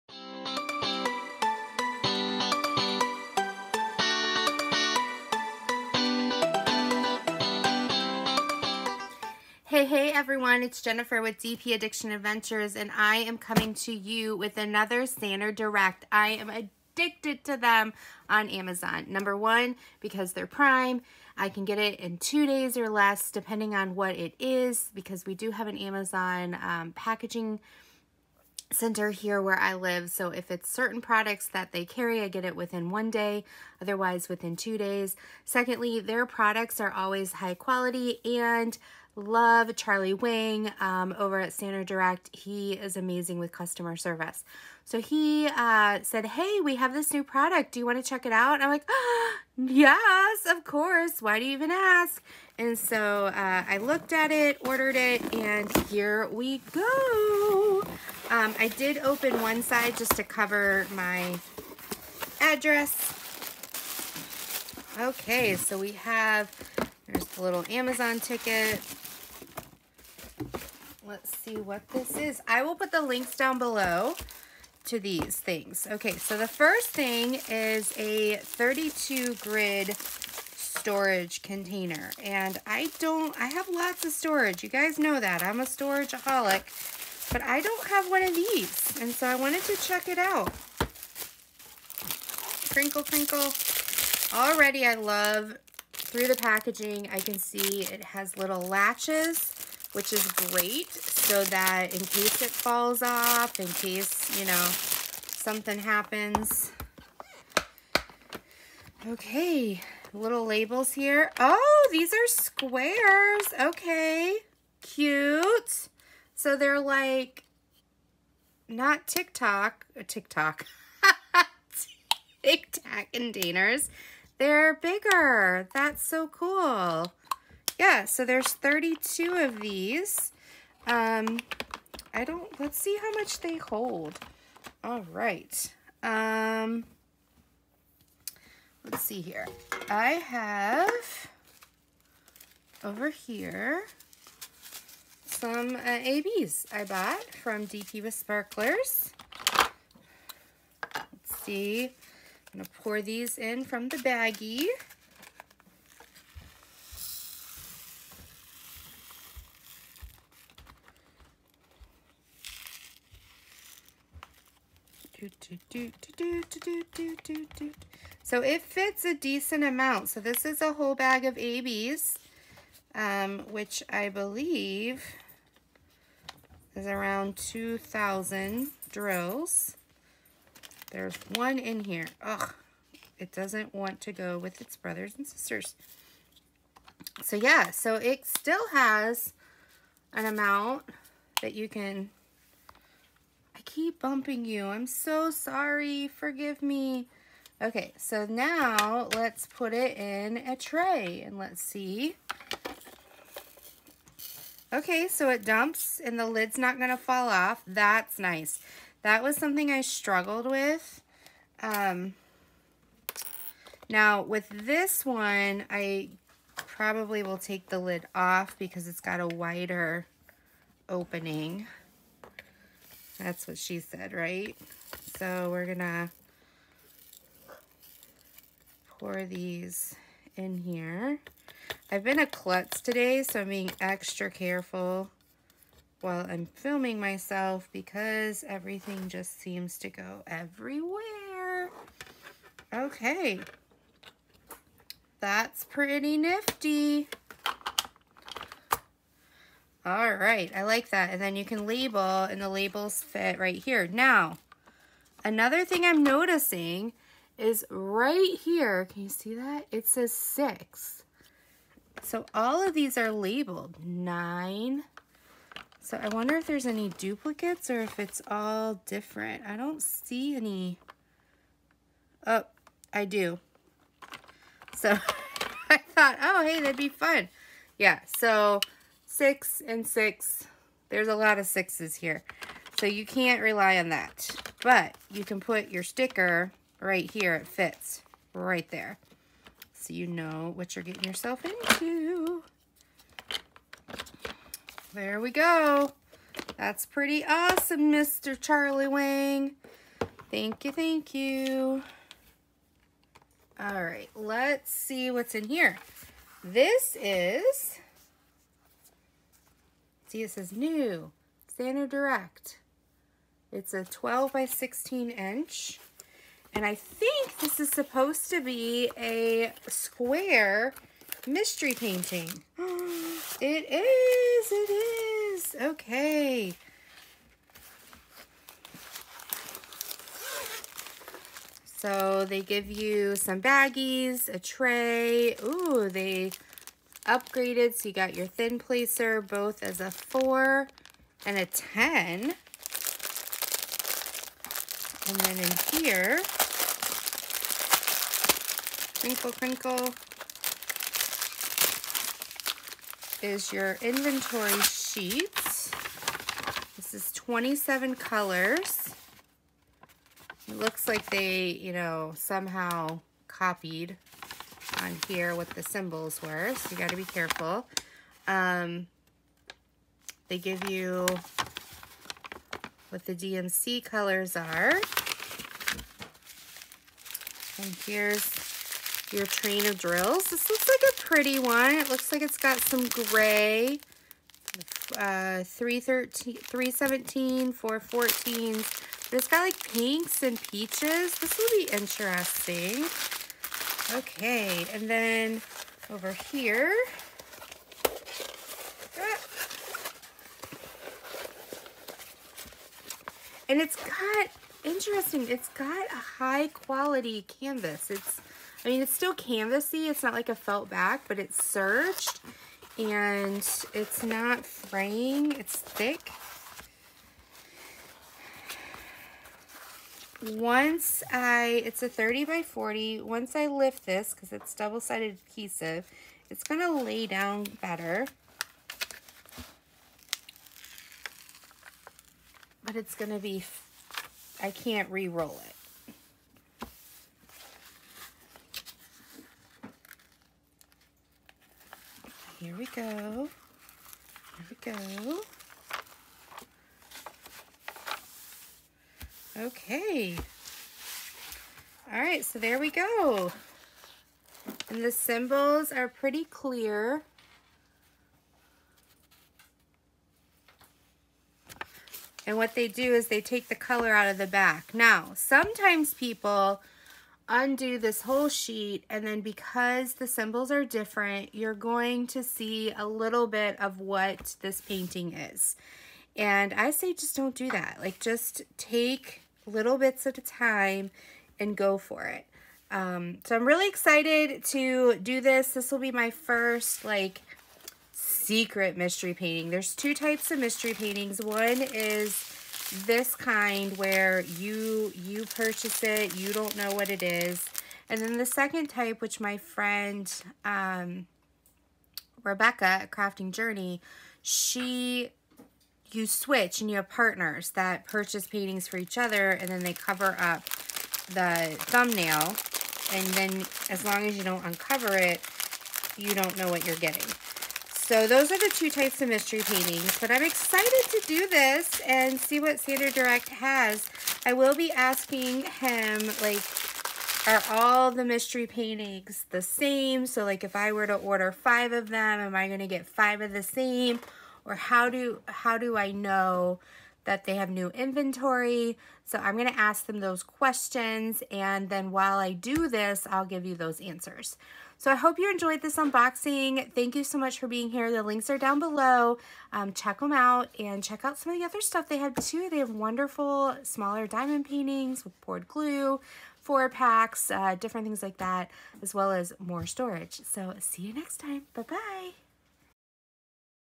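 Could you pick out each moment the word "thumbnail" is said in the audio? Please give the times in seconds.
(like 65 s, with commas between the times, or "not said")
511 s.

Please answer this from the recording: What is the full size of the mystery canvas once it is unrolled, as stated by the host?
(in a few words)
30 by 40.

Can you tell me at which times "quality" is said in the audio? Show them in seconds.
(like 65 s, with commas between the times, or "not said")
37 s, 406 s.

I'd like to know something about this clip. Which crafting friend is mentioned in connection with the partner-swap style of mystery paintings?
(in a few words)
Rebecca Crafting Journey.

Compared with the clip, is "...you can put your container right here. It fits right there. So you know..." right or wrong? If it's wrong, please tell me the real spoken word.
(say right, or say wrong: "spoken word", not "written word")
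wrong: "sticker", not "container".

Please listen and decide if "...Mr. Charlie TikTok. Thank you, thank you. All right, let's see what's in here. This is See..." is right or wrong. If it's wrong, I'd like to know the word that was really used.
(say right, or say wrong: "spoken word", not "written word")
wrong: "Wang", not "TikTok".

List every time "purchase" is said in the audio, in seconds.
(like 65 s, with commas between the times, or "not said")
495 s, 507 s.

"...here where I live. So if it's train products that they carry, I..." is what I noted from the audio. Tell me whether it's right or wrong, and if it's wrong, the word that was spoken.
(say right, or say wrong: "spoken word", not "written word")
wrong: "certain", not "train".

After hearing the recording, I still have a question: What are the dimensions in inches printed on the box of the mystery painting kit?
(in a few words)
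12 by 16.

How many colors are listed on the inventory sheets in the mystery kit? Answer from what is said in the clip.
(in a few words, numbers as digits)
27.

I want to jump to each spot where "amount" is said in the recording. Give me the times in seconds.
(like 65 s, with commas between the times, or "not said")
169 s, 190 s.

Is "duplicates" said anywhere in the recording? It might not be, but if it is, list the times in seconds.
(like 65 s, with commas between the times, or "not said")
266 s.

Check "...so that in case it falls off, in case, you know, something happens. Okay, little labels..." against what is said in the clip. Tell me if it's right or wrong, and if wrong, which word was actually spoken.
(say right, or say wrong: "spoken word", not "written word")
right.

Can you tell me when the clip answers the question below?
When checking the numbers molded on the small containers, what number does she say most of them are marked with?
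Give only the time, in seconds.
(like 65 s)
263 s.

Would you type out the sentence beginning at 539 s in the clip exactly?
So I'm gonna ask them those questions and then while I do this, I'll give you those answers.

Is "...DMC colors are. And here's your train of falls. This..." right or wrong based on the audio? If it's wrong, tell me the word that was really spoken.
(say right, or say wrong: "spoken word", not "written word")
wrong: "drills", not "falls".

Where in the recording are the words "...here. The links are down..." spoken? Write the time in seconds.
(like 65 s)
547 s.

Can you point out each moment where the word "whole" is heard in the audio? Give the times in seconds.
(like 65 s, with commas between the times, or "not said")
170 s, 468 s.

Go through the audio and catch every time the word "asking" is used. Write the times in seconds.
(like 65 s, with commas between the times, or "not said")
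524 s.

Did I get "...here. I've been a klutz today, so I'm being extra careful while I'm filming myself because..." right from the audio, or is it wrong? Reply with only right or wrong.
right.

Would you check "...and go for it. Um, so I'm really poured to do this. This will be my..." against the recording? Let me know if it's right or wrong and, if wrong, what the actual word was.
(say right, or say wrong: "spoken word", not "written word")
wrong: "excited", not "poured".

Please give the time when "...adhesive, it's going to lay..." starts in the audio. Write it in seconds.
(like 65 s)
425 s.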